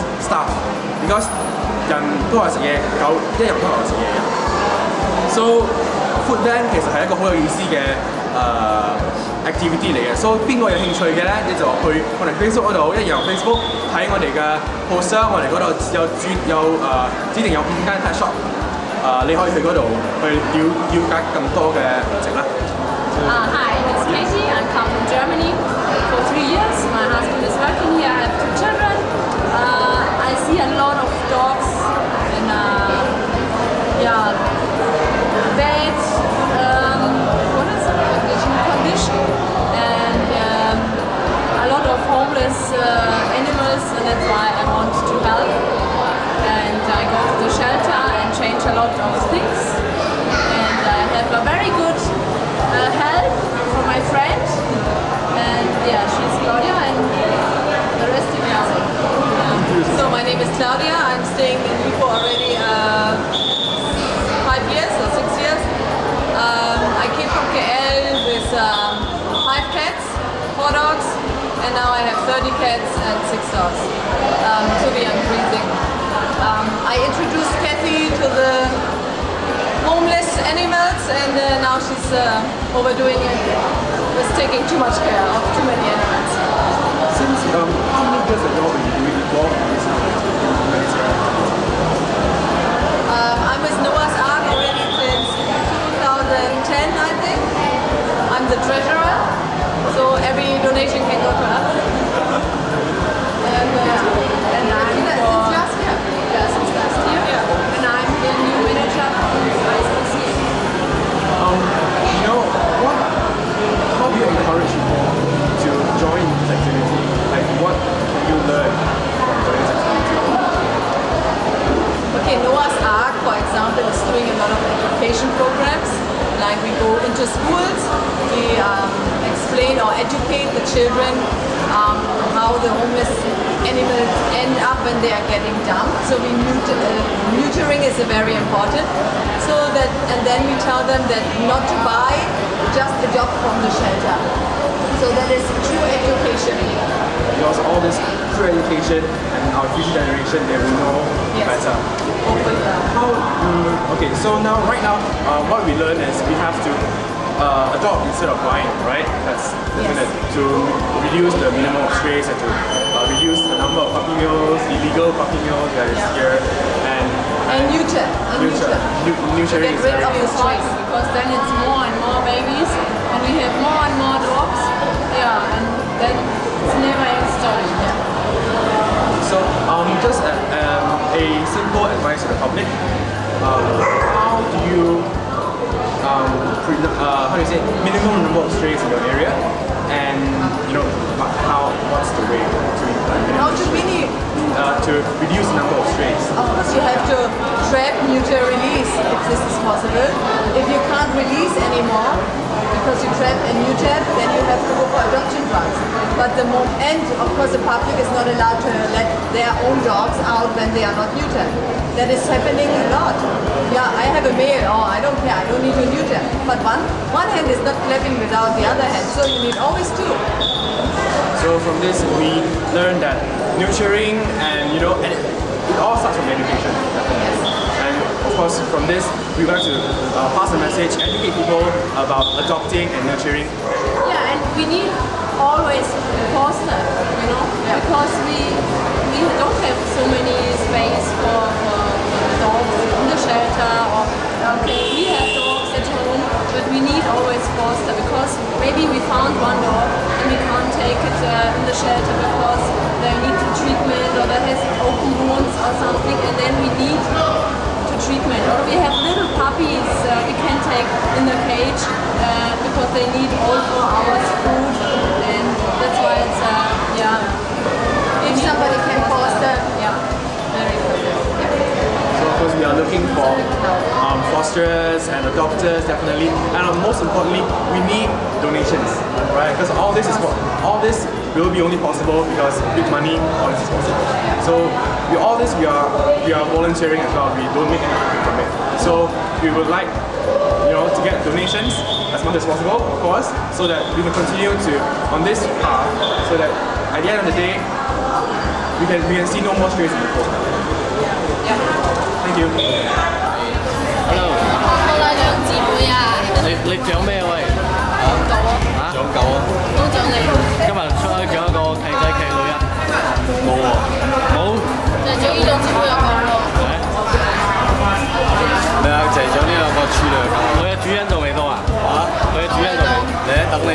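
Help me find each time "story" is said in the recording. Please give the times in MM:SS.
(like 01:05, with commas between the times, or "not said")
02:57.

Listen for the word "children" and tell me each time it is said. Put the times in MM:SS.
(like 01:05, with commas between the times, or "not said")
00:28.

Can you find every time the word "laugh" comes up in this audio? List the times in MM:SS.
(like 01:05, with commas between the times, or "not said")
not said.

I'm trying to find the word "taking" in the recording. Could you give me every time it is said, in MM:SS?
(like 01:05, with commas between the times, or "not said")
01:24.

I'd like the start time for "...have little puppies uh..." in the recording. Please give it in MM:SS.
04:18.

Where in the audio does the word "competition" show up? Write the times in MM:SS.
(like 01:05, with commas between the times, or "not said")
not said.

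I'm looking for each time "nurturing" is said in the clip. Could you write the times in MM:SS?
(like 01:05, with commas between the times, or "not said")
03:43, 03:53.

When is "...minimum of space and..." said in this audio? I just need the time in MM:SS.
02:41.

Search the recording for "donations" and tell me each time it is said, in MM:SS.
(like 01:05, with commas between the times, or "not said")
01:40, 04:38, 04:51.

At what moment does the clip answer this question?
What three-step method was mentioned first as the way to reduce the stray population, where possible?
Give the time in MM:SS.
03:17.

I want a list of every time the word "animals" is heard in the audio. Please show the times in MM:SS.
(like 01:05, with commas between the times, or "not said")
00:43, 01:20, 01:25.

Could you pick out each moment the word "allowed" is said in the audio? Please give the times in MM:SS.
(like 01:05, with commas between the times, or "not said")
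03:28.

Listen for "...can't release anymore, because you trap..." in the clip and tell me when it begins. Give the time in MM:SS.
03:20.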